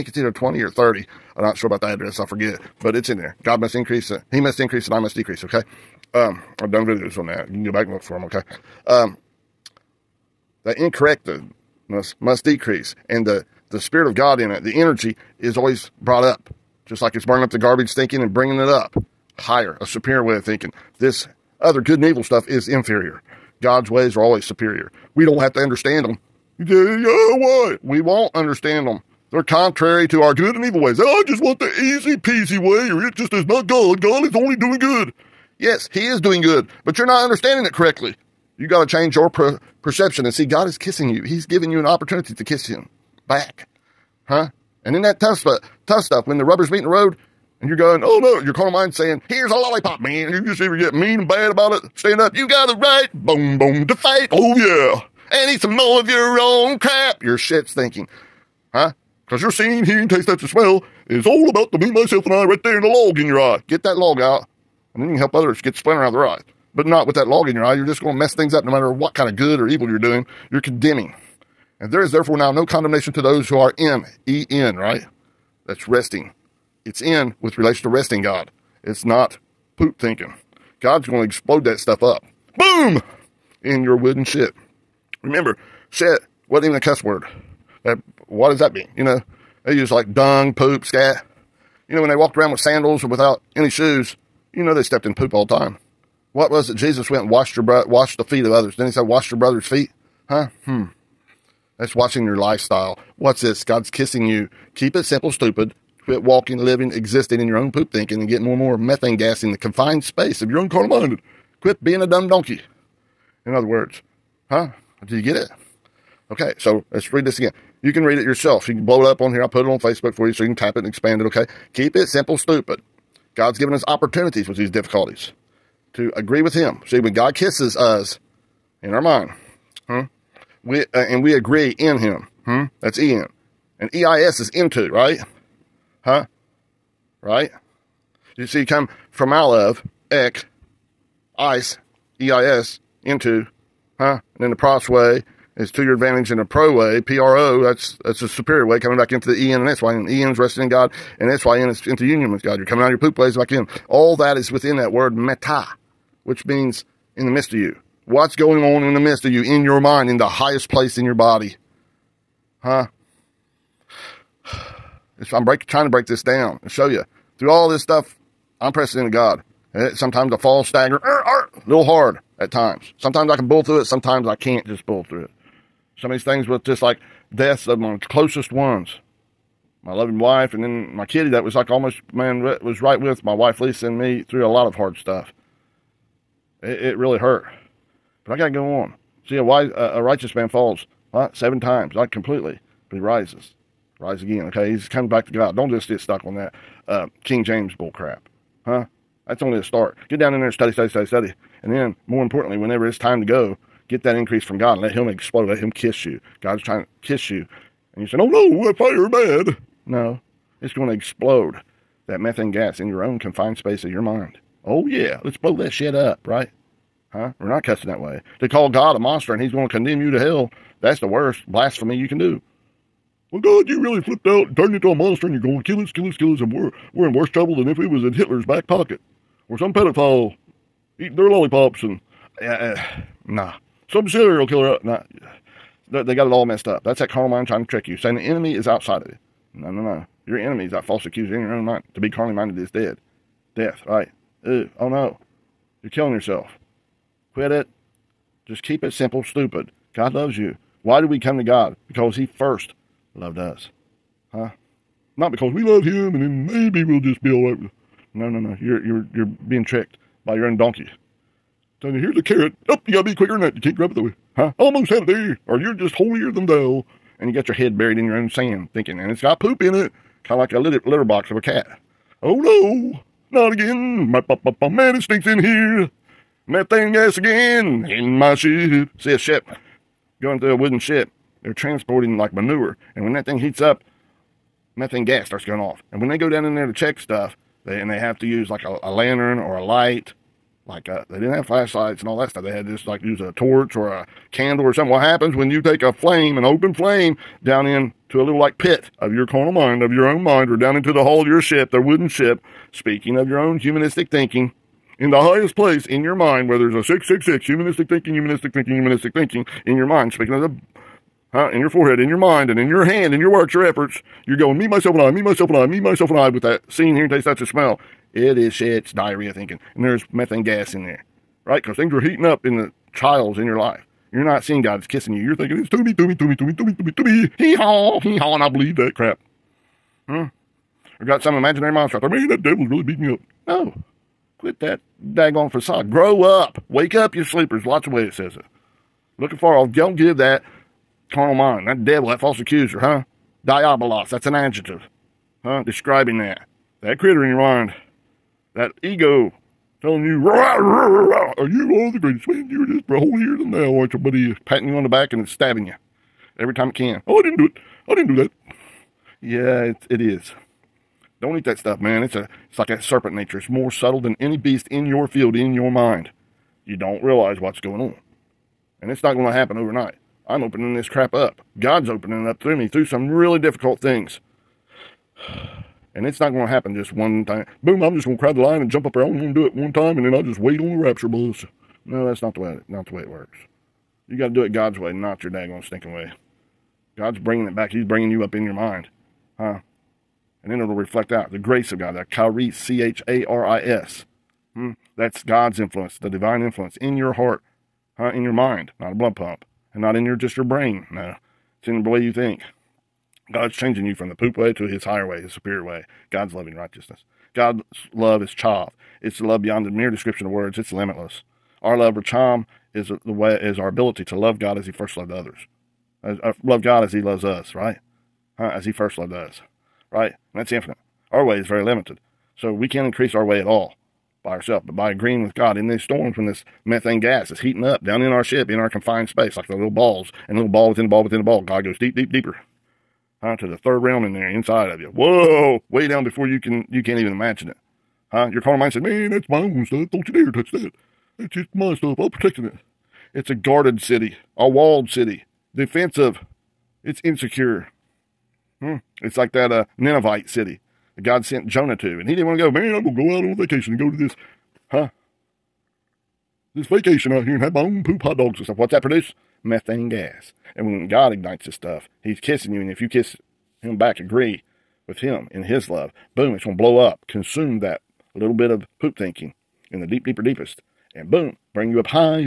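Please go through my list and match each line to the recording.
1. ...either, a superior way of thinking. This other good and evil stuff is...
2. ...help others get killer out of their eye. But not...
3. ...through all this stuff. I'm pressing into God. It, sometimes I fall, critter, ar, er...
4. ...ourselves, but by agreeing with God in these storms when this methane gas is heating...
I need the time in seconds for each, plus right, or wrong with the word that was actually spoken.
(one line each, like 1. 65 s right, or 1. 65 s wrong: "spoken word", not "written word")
1. 19 s wrong: "higher", not "either"
2. 65 s wrong: "splinter", not "killer"
3. 167 s wrong: "stagger", not "critter"
4. 424 s right.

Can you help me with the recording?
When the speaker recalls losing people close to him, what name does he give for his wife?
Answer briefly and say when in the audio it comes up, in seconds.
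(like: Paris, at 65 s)
Lisa, at 183 s.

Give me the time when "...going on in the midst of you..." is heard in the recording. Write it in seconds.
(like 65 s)
158 s.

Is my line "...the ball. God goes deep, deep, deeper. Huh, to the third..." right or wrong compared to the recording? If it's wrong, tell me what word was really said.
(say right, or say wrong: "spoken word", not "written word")
right.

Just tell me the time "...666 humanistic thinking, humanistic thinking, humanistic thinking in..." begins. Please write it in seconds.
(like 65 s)
306 s.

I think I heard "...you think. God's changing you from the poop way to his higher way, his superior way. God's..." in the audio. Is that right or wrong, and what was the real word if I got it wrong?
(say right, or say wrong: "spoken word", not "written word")
right.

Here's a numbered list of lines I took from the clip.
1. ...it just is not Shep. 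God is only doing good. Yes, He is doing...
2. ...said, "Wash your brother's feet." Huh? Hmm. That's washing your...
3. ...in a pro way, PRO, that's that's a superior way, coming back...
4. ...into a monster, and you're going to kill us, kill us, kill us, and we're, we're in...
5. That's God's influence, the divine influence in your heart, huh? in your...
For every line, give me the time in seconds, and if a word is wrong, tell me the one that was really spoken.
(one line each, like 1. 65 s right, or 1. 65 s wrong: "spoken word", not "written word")
1. 33 s wrong: "God", not "Shep"
2. 98 s right
3. 146 s right
4. 224 s right
5. 394 s right.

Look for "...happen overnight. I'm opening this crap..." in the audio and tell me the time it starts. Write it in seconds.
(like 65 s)
369 s.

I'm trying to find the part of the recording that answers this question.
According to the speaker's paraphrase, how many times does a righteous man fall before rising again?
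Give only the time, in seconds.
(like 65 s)
191 s.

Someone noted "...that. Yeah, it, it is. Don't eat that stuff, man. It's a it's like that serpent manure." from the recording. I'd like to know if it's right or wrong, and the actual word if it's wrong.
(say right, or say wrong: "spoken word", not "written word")
wrong: "nature", not "manure".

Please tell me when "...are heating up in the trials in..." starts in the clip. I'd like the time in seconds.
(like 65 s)
321 s.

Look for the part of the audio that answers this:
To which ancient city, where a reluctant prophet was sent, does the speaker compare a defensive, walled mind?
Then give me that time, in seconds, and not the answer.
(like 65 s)
449 s.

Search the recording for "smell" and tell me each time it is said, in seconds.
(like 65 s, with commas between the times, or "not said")
60 s, 317 s.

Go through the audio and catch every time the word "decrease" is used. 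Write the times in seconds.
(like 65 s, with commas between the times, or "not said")
5 s, 12 s.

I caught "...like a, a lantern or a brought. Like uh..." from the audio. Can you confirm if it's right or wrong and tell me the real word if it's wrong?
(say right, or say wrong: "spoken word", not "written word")
wrong: "light", not "brought".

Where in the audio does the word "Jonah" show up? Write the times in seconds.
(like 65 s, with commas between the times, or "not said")
451 s.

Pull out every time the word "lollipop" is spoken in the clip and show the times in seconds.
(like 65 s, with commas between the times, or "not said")
49 s, 231 s.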